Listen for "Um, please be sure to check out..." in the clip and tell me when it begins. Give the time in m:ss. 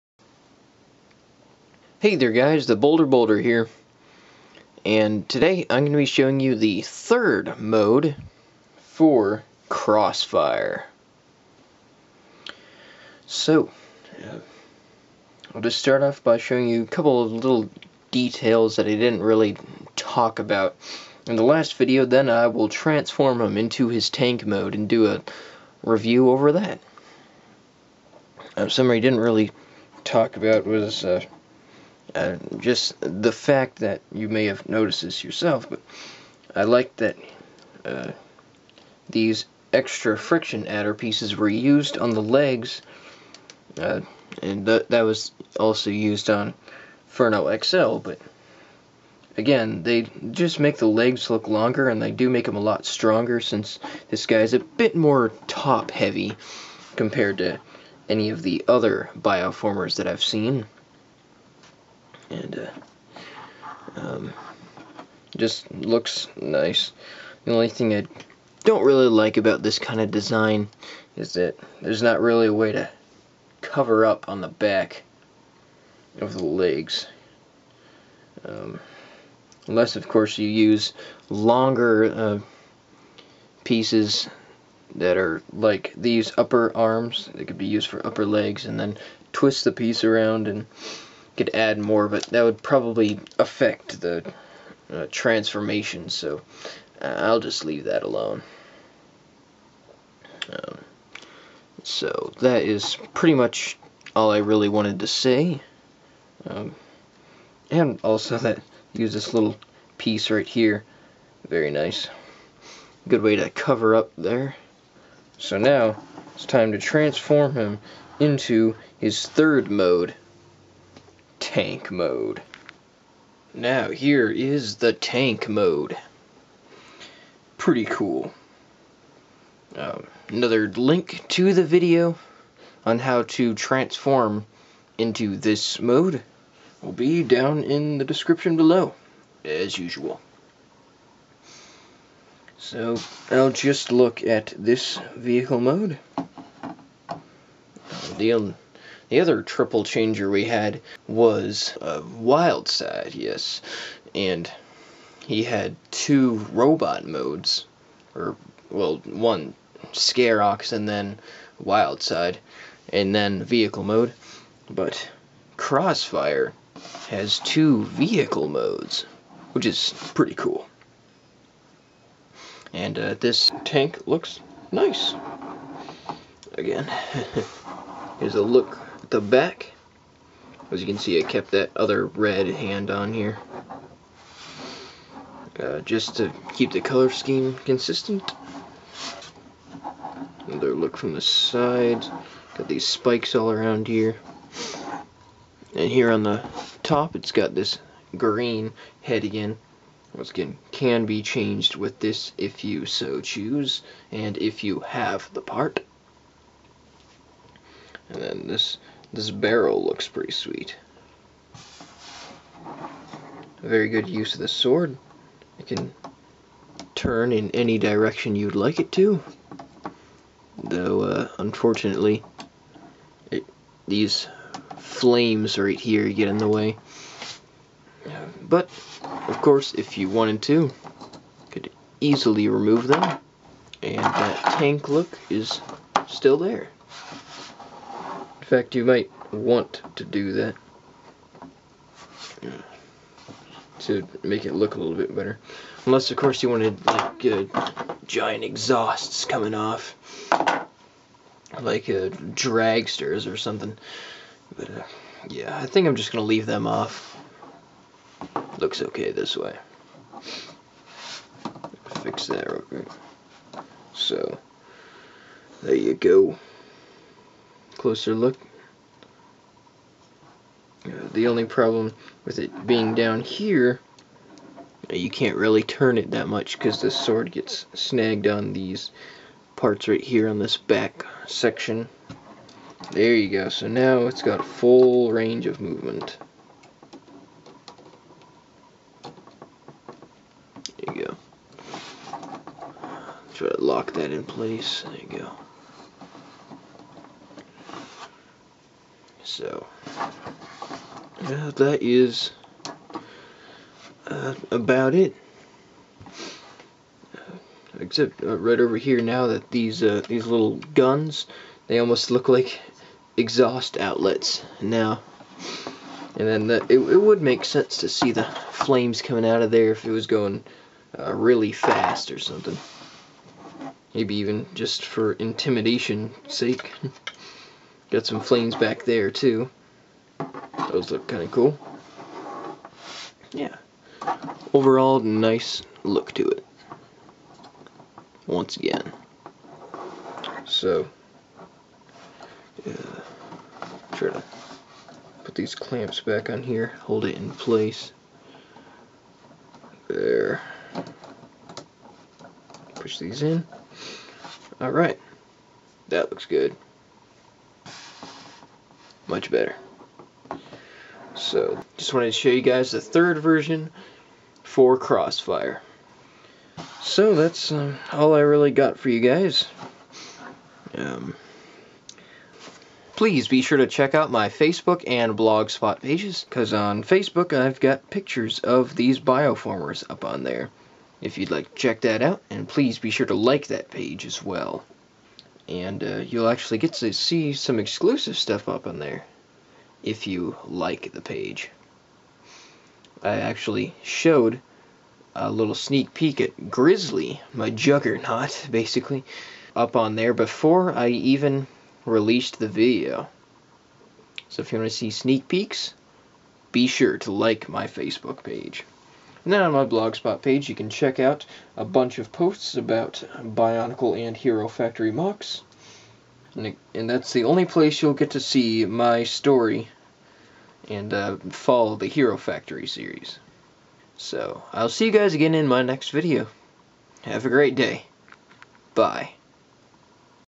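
6:10.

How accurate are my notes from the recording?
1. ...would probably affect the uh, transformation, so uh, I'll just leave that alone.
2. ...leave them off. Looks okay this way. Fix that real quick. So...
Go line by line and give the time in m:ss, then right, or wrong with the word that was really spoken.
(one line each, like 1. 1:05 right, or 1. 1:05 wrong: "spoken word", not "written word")
1. 1:32 right
2. 4:16 right.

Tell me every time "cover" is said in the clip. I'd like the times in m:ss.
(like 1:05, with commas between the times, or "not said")
1:13, 1:53.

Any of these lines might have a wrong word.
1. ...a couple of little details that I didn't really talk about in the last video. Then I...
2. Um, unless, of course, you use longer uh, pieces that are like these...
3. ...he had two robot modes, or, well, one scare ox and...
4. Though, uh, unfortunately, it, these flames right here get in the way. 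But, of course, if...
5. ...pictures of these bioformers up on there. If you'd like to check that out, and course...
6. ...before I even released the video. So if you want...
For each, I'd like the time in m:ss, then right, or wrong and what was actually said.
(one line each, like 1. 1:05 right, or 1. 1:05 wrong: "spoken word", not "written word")
1. 0:16 right
2. 1:18 right
3. 2:35 right
4. 3:40 right
5. 6:17 wrong: "please", not "course"
6. 6:40 right.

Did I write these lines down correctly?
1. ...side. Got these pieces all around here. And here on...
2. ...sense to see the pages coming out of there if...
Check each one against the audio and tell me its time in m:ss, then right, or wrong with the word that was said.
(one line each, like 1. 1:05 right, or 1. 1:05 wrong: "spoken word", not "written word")
1. 3:11 wrong: "spikes", not "pieces"
2. 5:17 wrong: "flames", not "pages".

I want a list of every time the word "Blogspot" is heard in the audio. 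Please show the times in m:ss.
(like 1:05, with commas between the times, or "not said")
6:15, 6:49.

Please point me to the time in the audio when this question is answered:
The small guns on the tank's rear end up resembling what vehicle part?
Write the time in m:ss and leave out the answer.
5:13.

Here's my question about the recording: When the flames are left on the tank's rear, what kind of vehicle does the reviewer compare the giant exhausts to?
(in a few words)
Dragsters.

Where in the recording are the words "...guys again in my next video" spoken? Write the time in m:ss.
7:04.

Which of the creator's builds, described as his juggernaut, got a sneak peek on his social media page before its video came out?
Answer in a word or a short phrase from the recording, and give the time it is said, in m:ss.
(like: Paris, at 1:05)
Grizzly, at 6:36.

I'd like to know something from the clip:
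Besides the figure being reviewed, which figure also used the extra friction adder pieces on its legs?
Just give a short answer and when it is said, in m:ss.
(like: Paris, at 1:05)
Furno XL, at 0:47.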